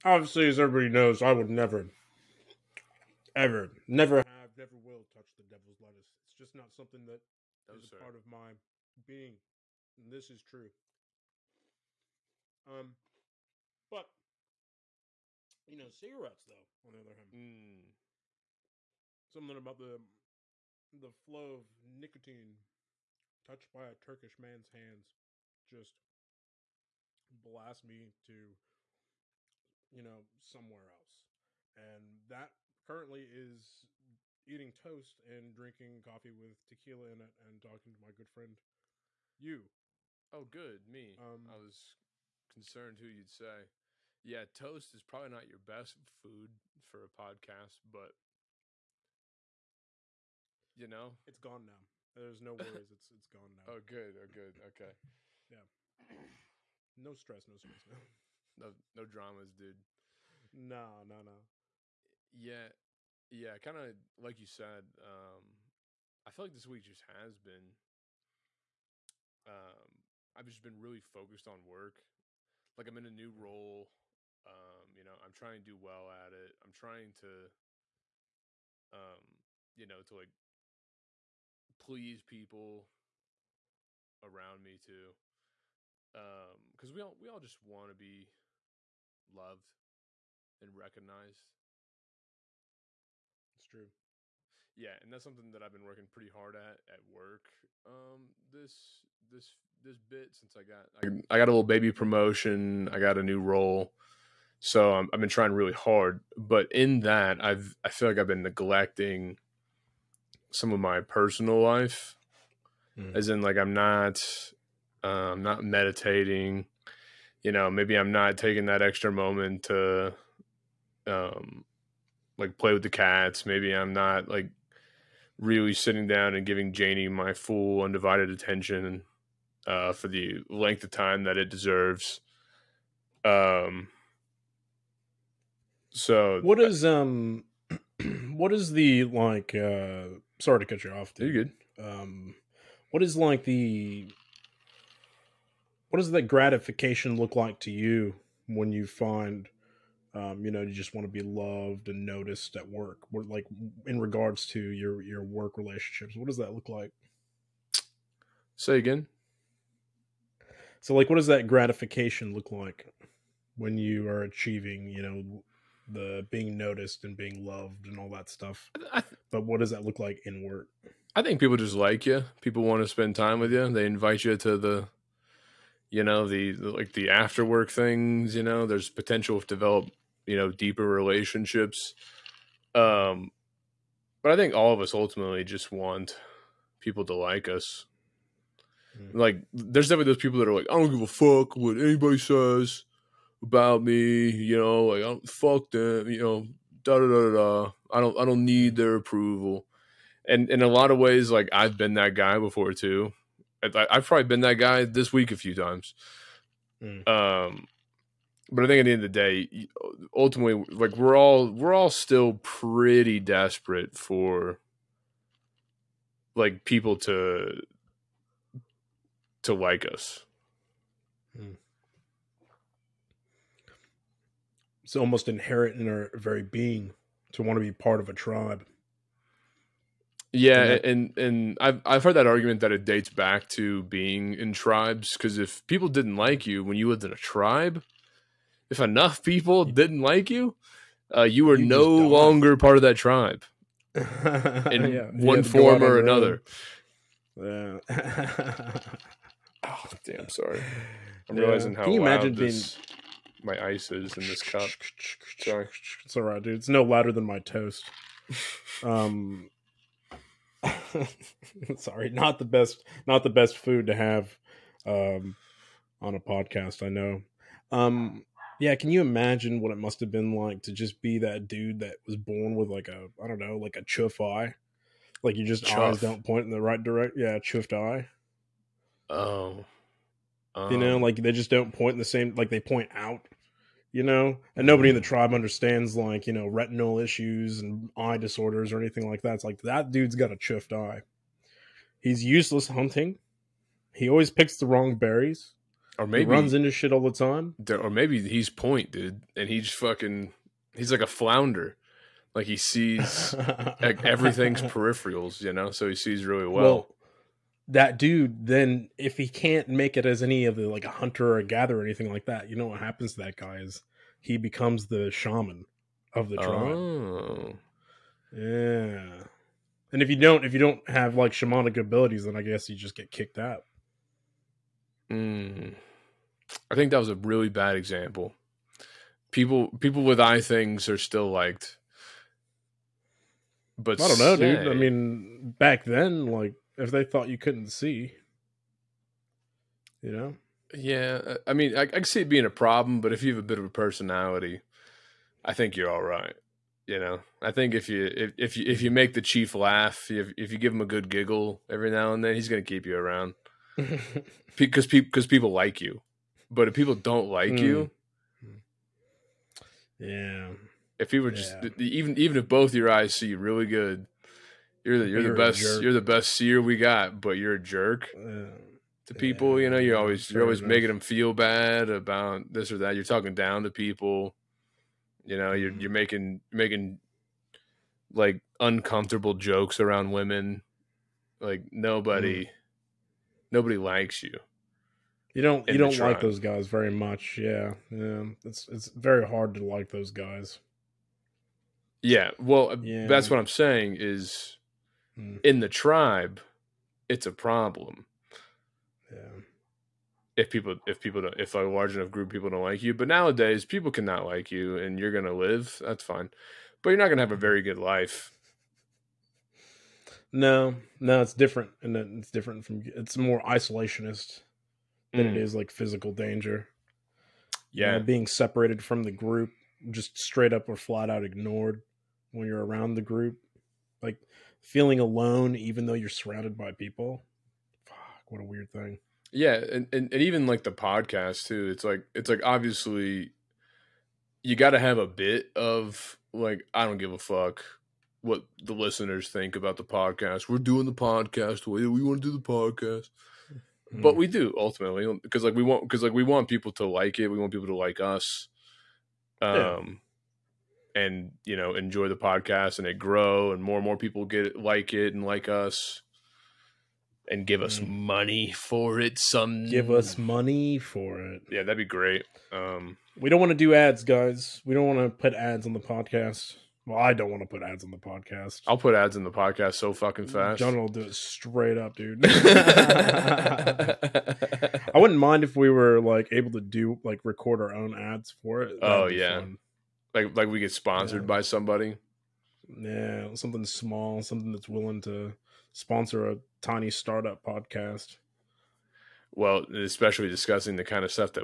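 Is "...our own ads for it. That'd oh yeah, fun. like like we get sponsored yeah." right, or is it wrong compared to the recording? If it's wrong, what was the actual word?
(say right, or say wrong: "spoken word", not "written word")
right.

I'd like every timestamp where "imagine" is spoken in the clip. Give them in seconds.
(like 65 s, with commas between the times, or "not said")
252 s, 268 s.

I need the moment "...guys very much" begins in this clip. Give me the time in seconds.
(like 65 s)
386 s.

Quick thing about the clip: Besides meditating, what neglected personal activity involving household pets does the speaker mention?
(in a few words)
play with the cats.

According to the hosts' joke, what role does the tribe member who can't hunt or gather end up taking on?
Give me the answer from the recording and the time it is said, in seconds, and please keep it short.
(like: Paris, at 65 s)
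shaman, at 315 s.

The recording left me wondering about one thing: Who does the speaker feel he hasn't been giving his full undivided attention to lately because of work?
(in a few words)
Janie.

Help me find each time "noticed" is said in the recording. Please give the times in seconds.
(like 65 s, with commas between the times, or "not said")
152 s, 166 s.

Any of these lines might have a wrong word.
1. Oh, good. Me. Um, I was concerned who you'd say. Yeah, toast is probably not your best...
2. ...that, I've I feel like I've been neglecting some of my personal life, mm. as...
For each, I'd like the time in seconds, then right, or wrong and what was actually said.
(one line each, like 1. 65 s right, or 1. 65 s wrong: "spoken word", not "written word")
1. 40 s right
2. 107 s right.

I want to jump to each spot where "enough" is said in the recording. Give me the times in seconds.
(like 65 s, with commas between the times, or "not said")
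238 s, 401 s.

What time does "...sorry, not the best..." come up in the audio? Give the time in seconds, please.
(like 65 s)
261 s.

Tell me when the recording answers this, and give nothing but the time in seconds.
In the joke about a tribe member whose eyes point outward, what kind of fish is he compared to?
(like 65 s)
301 s.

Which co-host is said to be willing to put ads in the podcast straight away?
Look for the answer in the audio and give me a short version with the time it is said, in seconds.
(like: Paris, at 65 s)
John, at 470 s.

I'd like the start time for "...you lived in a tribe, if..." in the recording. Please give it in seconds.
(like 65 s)
236 s.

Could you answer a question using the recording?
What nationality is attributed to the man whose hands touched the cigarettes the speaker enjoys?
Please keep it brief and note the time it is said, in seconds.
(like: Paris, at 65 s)
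Turkish, at 23 s.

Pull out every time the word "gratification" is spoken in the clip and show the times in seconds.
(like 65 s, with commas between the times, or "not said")
146 s, 161 s.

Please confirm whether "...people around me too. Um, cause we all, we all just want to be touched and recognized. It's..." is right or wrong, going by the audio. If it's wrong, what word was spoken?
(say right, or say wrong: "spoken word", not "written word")
wrong: "loved", not "touched".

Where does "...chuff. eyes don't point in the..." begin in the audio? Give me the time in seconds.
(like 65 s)
275 s.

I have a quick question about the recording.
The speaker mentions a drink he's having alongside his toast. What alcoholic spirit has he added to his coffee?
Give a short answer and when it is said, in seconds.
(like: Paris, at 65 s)
tequila, at 36 s.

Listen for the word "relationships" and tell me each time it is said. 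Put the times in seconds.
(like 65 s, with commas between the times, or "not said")
155 s, 180 s.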